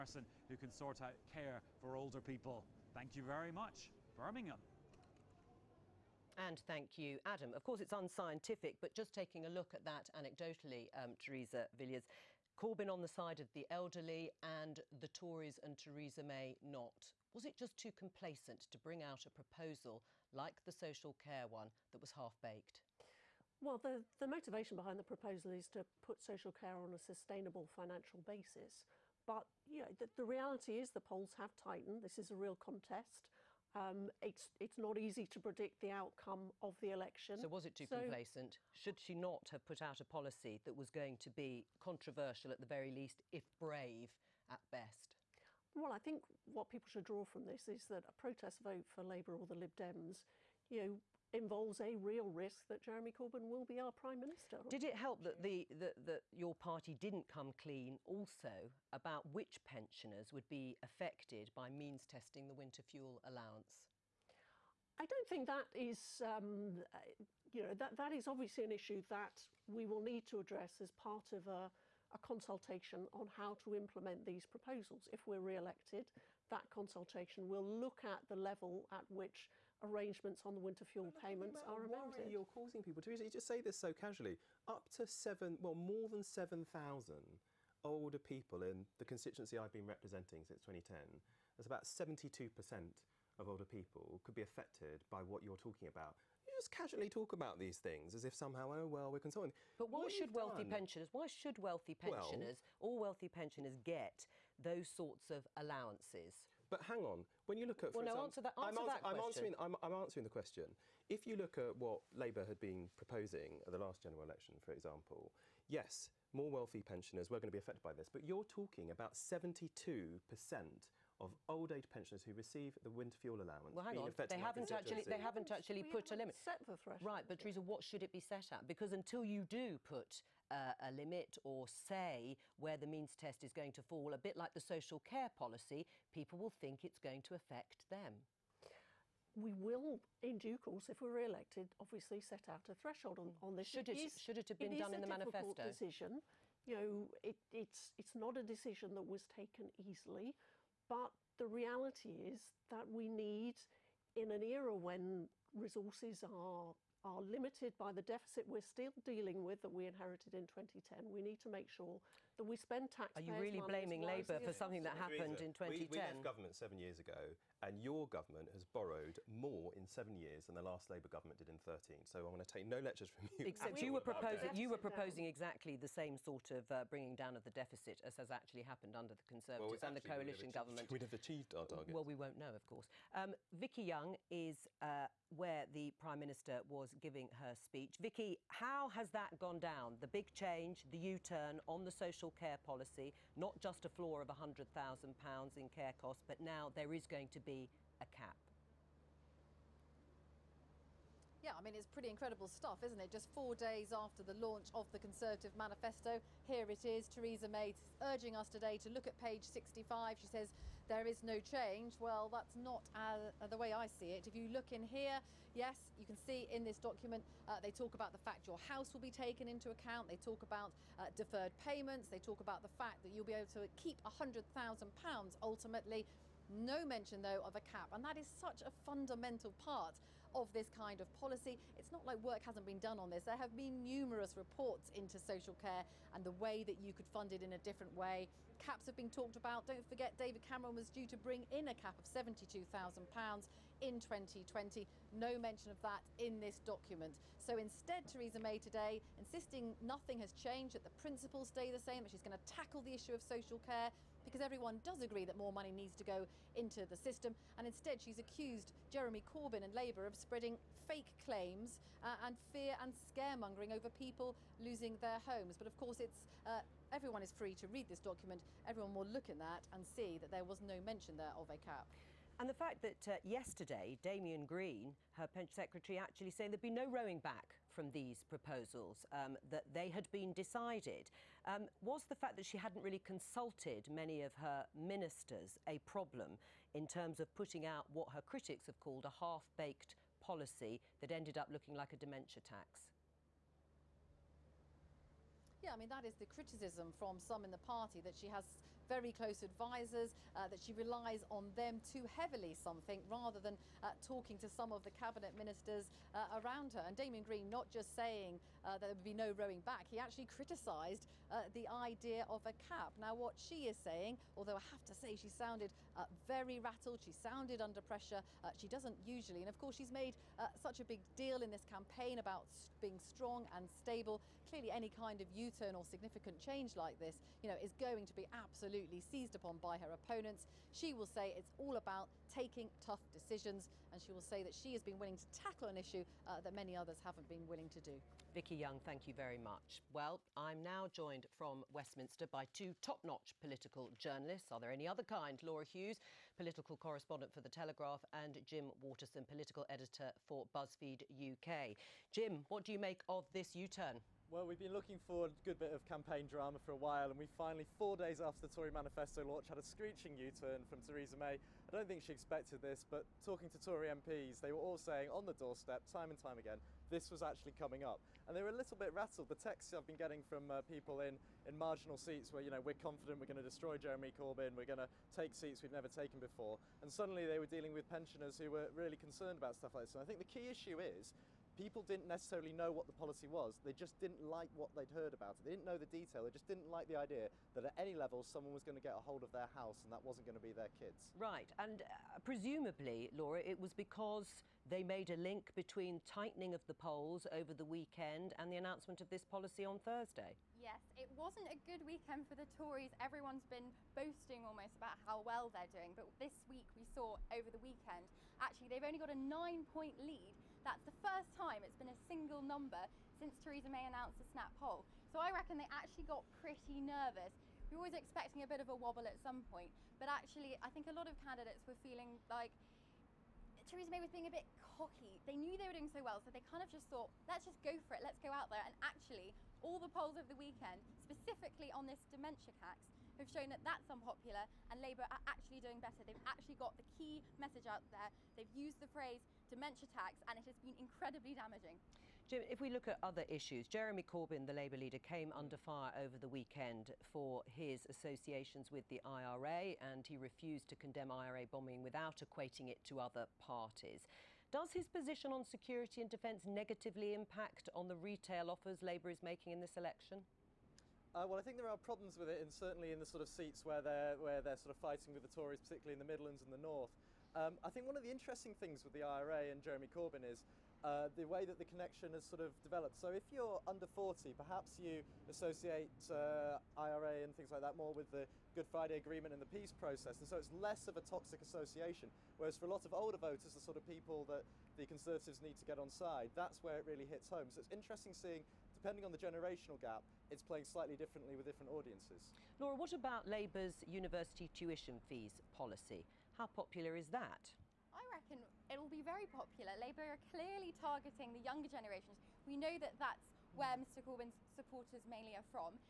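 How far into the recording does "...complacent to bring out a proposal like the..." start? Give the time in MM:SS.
00:17.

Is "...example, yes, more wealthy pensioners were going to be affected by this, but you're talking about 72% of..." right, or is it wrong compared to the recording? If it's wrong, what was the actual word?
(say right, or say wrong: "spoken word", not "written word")
right.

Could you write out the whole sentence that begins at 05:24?
Clearly, any kind of U-turn or significant change like this, you know, is going to be absolutely seized upon by her opponents.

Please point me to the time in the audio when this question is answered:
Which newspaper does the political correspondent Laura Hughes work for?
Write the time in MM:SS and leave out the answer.
05:47.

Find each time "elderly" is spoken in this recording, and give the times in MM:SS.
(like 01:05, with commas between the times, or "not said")
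00:13.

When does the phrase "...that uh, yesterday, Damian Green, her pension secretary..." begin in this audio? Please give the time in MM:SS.
04:32.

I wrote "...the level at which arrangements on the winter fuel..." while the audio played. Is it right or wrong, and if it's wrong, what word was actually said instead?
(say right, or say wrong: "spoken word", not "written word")
right.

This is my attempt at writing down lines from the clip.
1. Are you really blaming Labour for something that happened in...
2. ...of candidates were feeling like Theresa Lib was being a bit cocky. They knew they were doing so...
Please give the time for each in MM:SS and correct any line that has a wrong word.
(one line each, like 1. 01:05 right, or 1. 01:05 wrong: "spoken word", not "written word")
1. 02:43 right
2. 07:01 wrong: "May", not "Lib".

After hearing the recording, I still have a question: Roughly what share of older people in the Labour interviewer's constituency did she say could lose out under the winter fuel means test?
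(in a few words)
72 percent.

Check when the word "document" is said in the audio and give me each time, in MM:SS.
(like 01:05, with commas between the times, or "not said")
03:36, 04:06, 04:28.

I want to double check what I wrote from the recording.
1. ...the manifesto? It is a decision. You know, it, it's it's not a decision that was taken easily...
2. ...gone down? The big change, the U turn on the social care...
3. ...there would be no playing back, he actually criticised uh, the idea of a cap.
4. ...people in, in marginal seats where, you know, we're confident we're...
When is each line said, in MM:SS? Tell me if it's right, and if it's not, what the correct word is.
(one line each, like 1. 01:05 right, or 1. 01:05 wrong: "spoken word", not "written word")
1. 02:25 right
2. 03:09 right
3. 05:08 wrong: "rowing", not "playing"
4. 06:10 right.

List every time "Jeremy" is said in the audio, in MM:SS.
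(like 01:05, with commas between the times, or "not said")
00:52, 04:18, 06:13, 07:23, 07:49.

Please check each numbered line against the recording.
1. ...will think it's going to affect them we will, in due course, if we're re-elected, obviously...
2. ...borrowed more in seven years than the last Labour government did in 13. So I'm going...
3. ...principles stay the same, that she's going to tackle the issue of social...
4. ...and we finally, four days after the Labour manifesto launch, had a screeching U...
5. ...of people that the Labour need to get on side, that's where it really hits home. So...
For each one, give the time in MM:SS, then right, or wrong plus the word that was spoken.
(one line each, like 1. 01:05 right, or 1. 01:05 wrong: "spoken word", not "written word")
1. 02:16 right
2. 02:48 right
3. 04:10 right
4. 05:57 wrong: "Tory", not "Labour"
5. 08:03 wrong: "Conservatives", not "Labour".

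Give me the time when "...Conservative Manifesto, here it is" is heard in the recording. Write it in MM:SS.
03:24.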